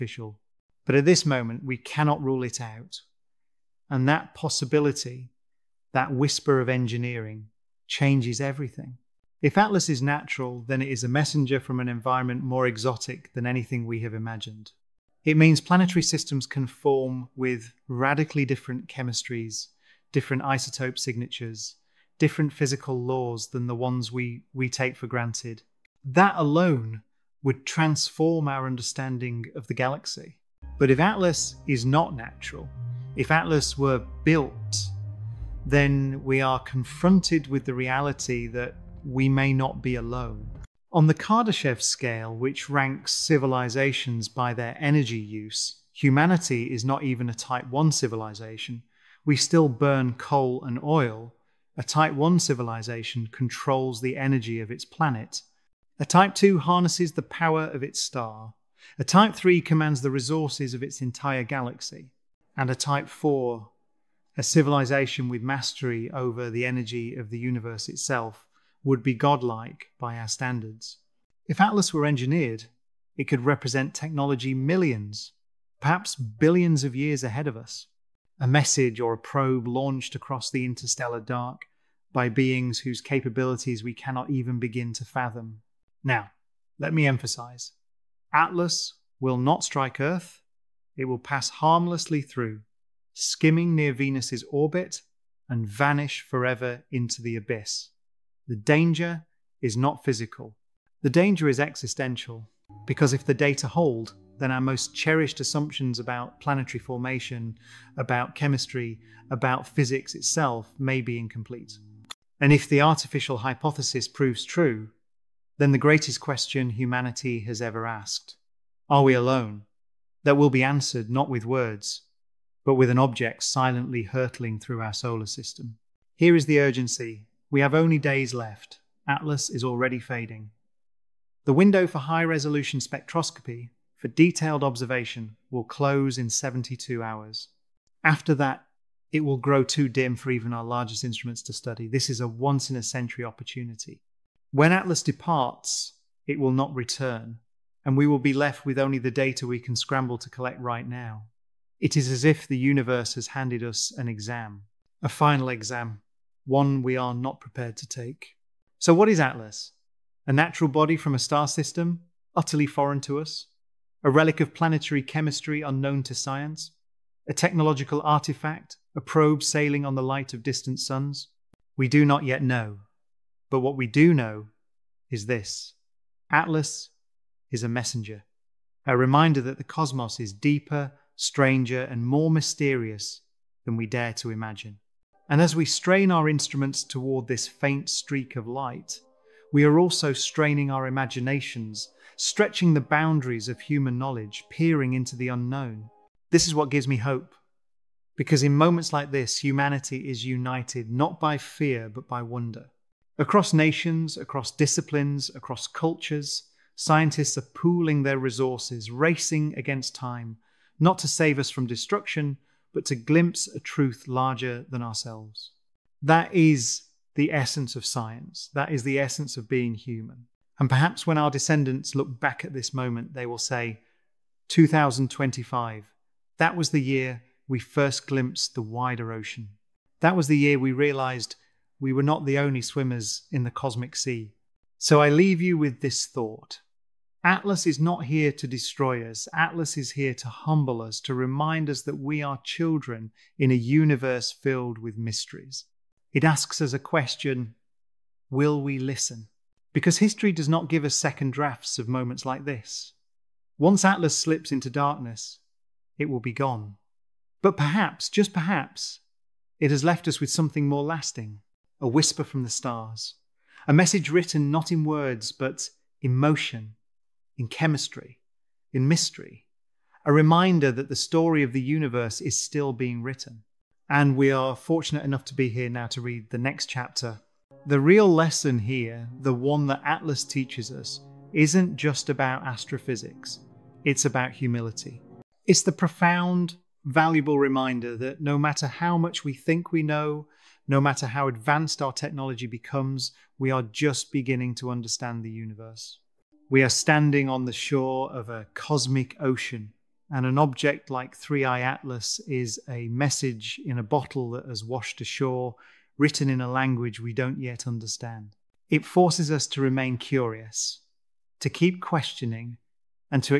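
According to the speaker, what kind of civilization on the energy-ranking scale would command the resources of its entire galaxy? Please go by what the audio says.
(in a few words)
Type 3.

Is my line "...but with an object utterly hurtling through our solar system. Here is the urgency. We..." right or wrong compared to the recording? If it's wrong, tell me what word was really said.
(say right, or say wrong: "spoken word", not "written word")
wrong: "silently", not "utterly".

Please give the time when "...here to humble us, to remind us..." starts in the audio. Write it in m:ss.
3:59.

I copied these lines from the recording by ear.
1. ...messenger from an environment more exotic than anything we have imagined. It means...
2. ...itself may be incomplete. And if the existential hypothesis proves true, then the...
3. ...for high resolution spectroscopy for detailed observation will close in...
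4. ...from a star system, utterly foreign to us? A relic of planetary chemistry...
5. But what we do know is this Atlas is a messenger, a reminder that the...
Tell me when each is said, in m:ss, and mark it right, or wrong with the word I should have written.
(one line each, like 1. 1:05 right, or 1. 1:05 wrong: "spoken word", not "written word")
1. 0:11 right
2. 1:50 wrong: "artificial", not "existential"
3. 2:11 right
4. 2:40 right
5. 2:53 right.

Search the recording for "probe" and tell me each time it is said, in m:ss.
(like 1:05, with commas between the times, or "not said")
1:19, 2:49.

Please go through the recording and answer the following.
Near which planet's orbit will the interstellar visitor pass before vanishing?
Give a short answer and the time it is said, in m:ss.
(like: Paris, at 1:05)
Venus, at 1:33.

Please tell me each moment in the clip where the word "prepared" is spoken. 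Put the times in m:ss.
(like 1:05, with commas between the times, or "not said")
2:37.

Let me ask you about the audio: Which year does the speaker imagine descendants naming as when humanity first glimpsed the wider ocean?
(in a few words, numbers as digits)
2025.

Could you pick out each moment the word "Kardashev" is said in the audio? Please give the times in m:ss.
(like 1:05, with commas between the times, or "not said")
0:41.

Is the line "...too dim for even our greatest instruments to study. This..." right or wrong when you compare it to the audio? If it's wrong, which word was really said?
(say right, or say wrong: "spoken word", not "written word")
wrong: "largest", not "greatest".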